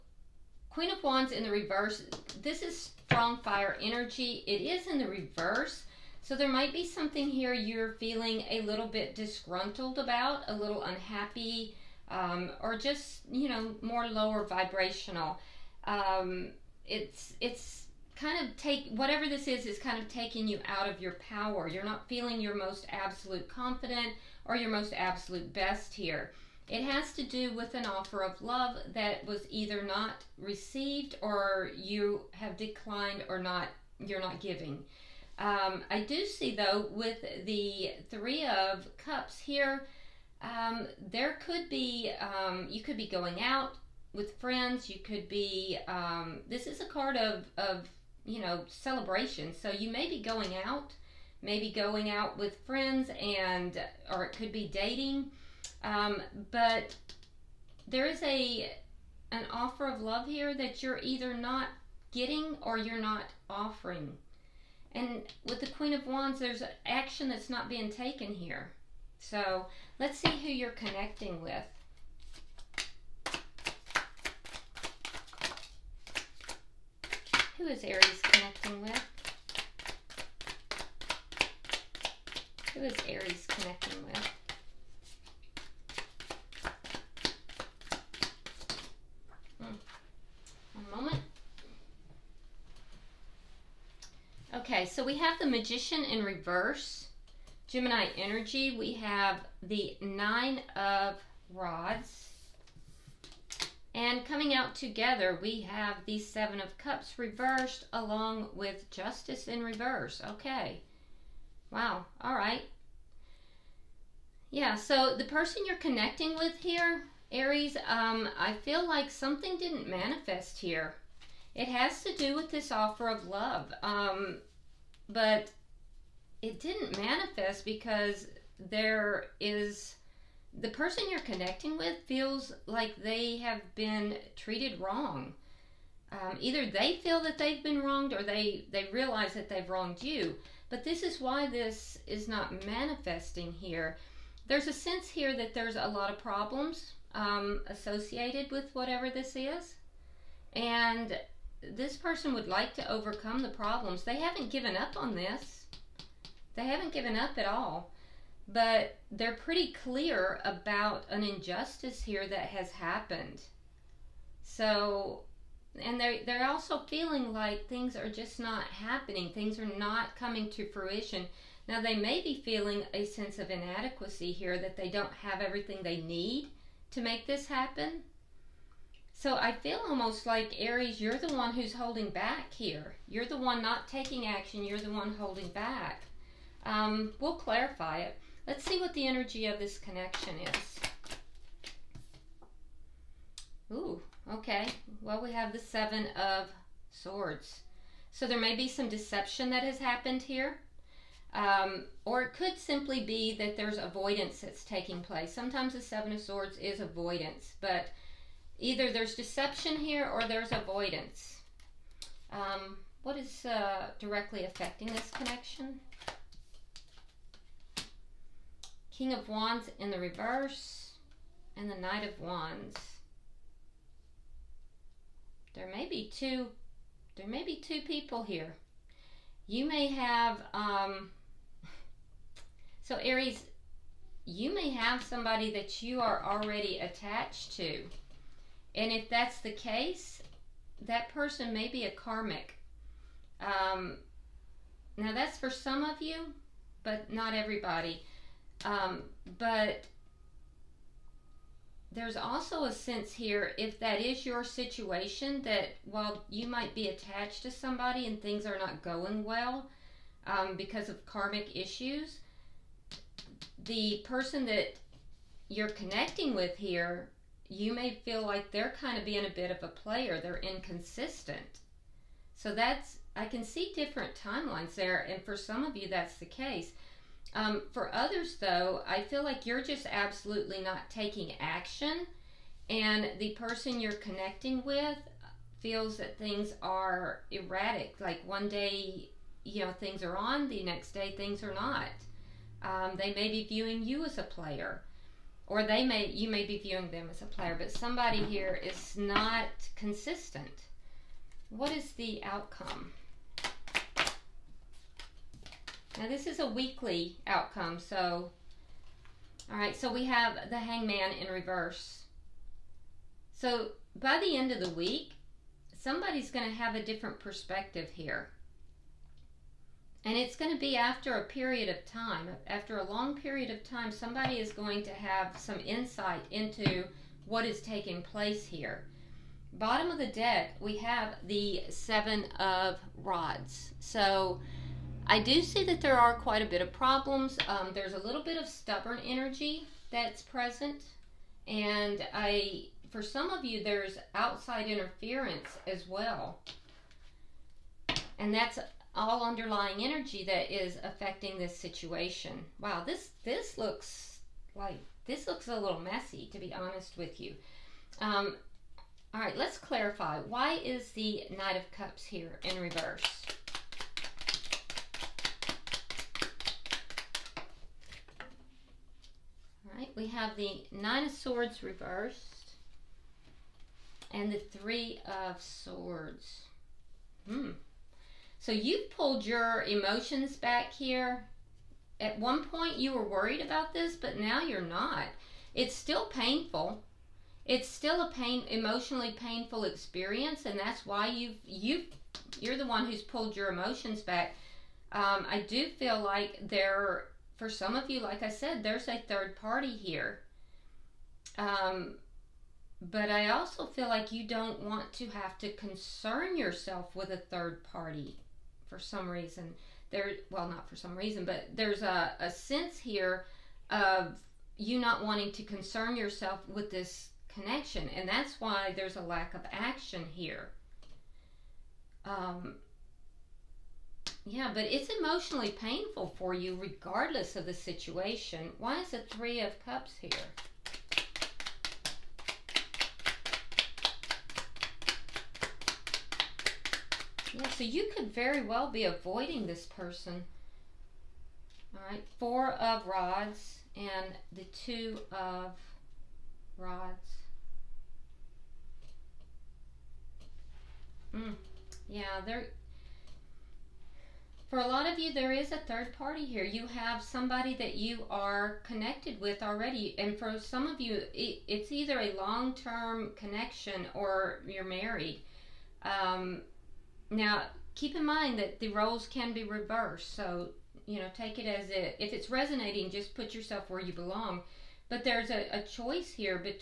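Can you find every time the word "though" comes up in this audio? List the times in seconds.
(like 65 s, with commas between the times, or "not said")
36 s, 278 s.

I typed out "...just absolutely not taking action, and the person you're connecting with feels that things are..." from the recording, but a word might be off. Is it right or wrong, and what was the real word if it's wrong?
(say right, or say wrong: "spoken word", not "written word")
right.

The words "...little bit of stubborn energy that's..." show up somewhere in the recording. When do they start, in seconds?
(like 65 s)
337 s.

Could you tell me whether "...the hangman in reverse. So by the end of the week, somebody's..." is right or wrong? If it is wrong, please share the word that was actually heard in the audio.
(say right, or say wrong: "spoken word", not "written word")
right.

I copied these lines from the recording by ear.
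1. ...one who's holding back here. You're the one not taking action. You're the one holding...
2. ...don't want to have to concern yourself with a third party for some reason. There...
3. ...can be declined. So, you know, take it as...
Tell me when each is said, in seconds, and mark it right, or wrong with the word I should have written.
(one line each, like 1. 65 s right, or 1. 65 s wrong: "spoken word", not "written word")
1. 181 s right
2. 404 s right
3. 469 s wrong: "reversed", not "declined".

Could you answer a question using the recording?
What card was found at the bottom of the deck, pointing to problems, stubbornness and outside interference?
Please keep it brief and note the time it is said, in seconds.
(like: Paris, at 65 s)
Seven of Rods, at 331 s.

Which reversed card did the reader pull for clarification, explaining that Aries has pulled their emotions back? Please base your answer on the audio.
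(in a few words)
Knight of Cups.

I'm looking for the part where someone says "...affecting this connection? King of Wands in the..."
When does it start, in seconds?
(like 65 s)
214 s.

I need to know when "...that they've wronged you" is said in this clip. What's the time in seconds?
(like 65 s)
139 s.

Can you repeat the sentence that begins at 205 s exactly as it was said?
Sometimes the Seven of Swords is avoidance, but either there's deception here or there's avoidance.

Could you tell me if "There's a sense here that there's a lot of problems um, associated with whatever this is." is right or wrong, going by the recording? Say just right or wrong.
right.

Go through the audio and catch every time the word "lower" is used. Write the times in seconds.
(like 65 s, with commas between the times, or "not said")
14 s.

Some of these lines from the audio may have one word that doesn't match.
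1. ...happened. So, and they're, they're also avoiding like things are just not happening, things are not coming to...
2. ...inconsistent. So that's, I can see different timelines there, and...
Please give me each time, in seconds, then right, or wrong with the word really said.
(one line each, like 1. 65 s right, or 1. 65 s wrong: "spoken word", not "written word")
1. 162 s wrong: "feeling", not "avoiding"
2. 270 s right.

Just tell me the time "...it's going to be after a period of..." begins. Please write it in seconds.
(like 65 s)
320 s.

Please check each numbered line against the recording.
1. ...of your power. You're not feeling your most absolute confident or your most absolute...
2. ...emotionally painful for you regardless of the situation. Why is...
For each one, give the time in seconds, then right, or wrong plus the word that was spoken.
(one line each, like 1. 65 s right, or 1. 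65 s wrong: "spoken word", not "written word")
1. 20 s right
2. 424 s right.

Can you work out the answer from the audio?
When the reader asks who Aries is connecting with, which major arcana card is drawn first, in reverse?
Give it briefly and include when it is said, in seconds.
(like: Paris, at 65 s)
The Magician, at 95 s.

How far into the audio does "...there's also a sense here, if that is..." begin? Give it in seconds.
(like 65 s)
251 s.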